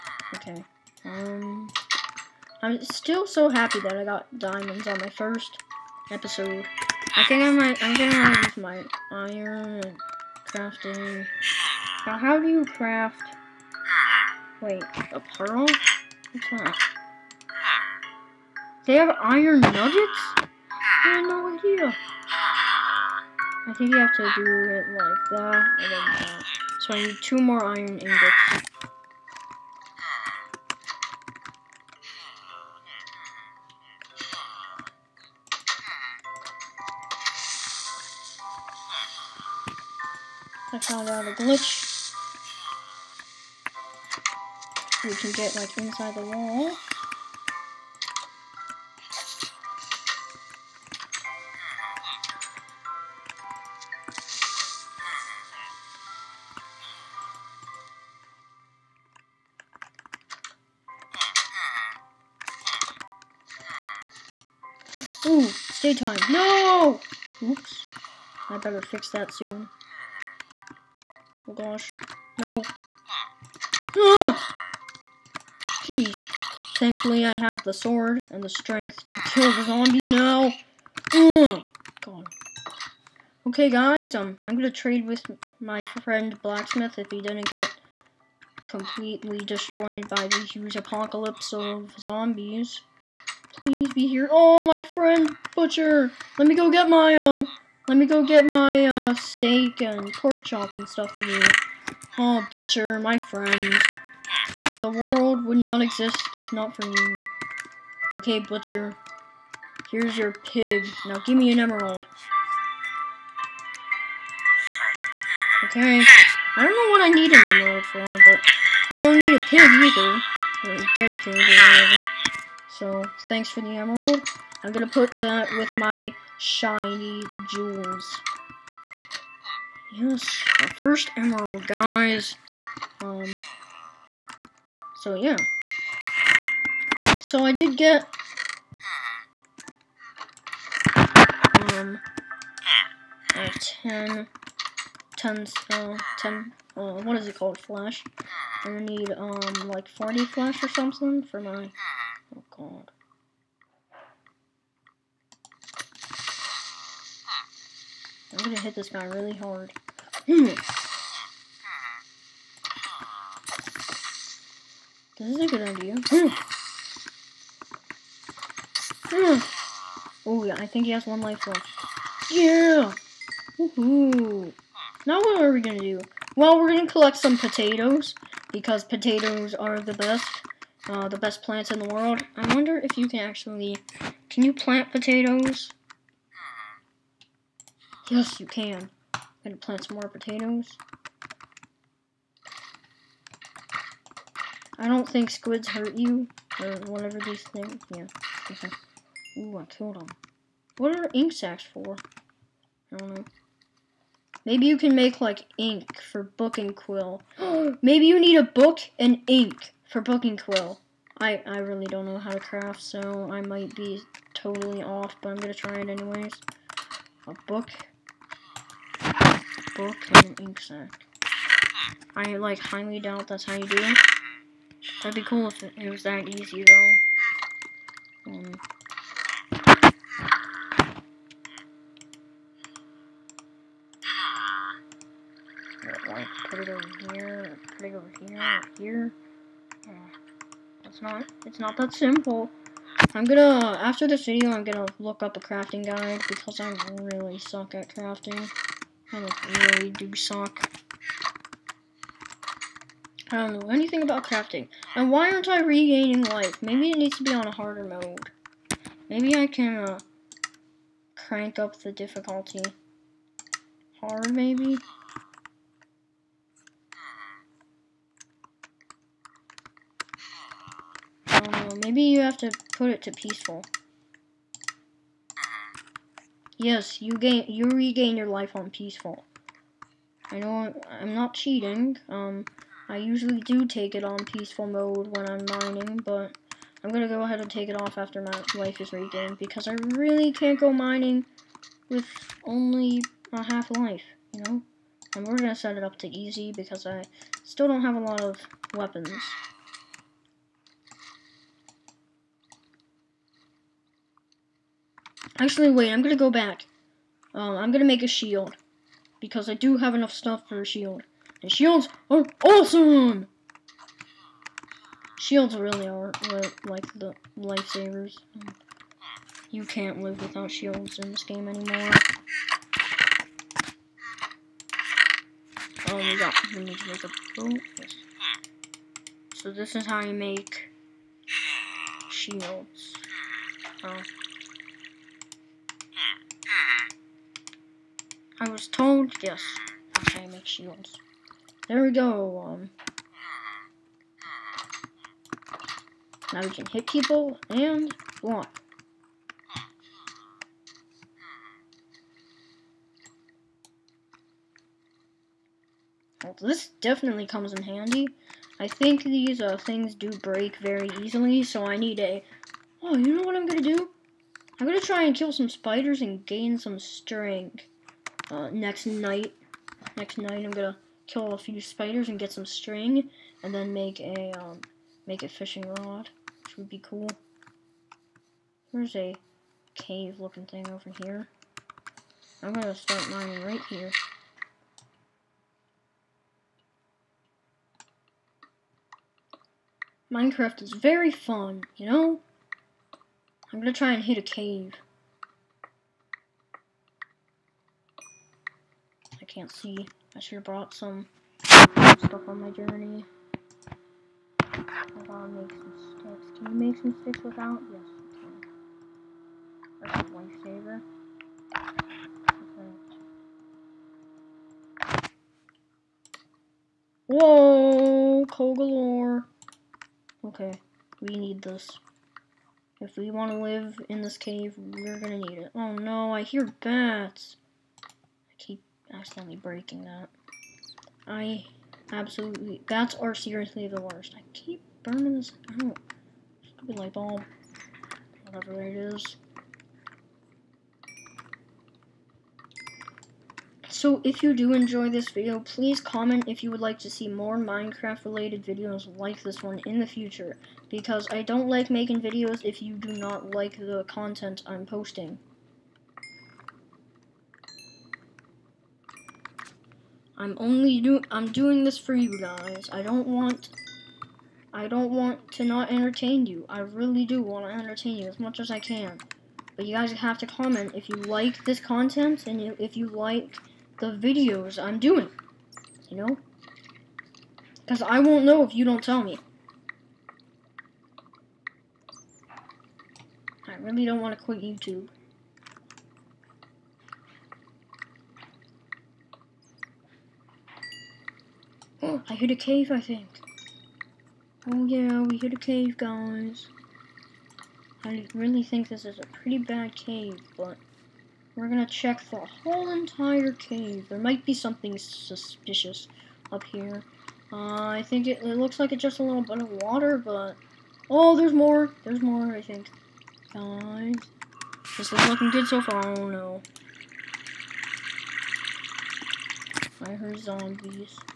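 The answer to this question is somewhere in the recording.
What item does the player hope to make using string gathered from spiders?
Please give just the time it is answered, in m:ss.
6:15.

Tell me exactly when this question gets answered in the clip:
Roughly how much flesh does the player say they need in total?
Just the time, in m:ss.
2:29.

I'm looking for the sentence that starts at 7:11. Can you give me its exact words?
I absolutely, that's or seriously the worst.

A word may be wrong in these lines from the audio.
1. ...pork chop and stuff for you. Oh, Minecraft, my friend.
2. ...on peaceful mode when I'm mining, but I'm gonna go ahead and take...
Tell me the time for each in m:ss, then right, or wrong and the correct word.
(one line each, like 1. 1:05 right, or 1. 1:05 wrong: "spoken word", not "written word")
1. 1:40 wrong: "Butcher", not "Minecraft"
2. 4:44 right.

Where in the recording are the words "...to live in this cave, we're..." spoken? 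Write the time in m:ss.
7:03.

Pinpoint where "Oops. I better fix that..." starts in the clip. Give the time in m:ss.
1:07.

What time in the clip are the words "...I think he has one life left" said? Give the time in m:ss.
2:50.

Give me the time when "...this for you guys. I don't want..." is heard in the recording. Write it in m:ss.
7:41.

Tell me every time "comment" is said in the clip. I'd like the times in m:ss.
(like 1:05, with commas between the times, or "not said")
7:25, 7:50.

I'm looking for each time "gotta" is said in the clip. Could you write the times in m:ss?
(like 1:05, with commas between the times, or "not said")
6:45.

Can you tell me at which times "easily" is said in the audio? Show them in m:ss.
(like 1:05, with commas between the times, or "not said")
6:01.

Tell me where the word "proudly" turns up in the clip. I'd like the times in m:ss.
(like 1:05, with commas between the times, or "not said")
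not said.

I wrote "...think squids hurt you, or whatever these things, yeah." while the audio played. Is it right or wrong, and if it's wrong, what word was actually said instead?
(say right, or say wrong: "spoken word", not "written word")
right.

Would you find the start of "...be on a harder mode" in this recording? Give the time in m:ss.
4:17.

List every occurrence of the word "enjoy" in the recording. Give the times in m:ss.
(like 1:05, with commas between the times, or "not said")
7:24.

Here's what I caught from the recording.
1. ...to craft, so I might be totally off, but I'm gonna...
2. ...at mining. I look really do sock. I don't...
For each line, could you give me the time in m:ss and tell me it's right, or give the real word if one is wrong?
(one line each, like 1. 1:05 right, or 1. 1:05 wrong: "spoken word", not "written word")
1. 3:32 right
2. 4:07 wrong: "crafting", not "mining".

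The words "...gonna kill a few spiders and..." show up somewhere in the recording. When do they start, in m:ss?
6:10.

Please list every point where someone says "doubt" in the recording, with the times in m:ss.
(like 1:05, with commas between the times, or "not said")
3:42.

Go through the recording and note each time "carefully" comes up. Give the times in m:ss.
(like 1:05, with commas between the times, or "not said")
not said.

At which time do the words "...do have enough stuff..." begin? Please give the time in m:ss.
5:09.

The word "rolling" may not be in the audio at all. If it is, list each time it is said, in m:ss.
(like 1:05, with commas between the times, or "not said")
not said.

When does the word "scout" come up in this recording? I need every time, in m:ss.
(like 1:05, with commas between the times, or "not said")
not said.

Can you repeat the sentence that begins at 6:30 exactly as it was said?
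Minecraft is very fun, you know?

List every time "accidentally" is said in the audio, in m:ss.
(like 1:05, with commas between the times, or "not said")
7:08.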